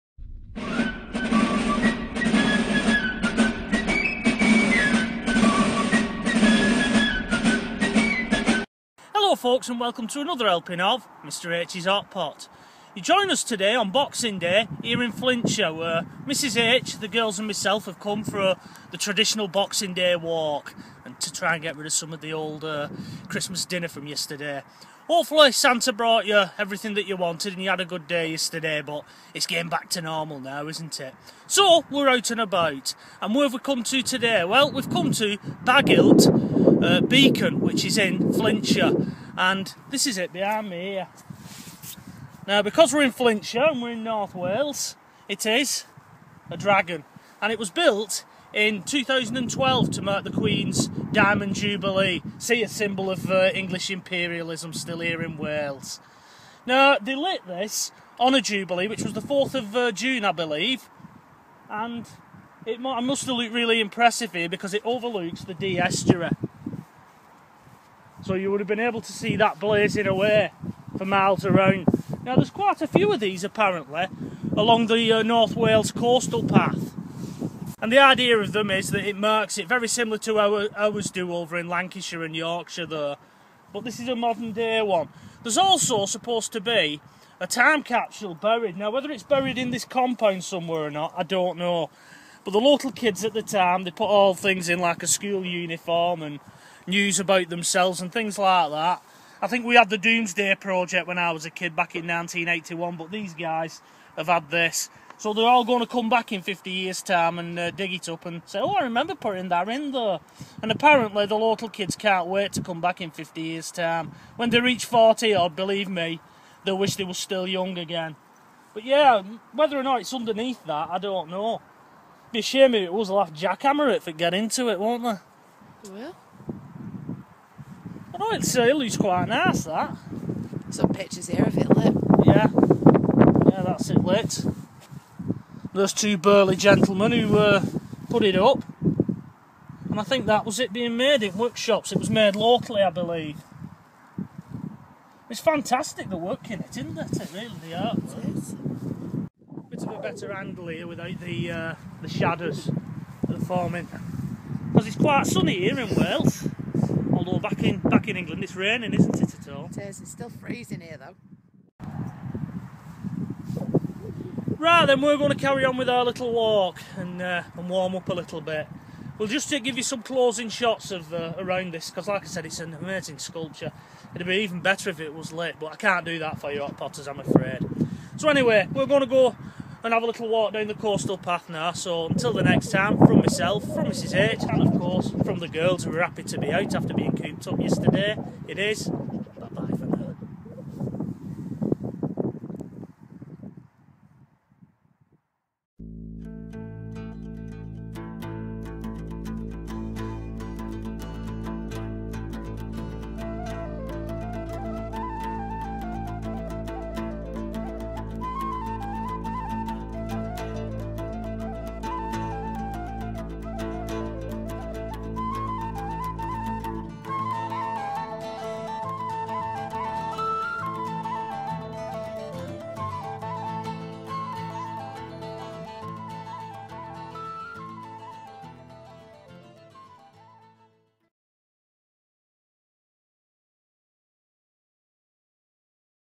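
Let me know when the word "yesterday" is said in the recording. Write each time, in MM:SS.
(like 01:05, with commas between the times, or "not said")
00:24, 00:28, 03:07.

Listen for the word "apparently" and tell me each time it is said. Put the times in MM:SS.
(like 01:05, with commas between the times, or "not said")
01:13, 01:50.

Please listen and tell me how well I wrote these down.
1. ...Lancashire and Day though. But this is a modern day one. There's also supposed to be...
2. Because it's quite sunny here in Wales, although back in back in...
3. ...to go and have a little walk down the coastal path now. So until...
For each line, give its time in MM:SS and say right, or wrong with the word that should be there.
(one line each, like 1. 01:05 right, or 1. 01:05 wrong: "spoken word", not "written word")
1. 01:21 wrong: "Yorkshire", not "Day"
2. 02:34 right
3. 02:59 right.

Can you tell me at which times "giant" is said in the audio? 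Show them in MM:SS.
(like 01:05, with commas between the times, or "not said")
not said.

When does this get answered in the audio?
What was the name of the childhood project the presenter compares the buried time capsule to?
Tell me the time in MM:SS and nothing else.
01:39.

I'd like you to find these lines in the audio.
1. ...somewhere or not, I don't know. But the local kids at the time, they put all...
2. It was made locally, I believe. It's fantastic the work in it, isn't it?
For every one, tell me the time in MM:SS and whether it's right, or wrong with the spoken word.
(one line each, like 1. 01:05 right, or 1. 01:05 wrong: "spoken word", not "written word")
1. 01:30 right
2. 02:21 right.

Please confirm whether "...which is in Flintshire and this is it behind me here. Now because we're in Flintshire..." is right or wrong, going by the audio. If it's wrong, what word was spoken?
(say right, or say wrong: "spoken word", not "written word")
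right.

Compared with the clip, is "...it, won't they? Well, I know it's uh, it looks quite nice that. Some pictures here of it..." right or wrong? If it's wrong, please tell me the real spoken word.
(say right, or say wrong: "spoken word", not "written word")
right.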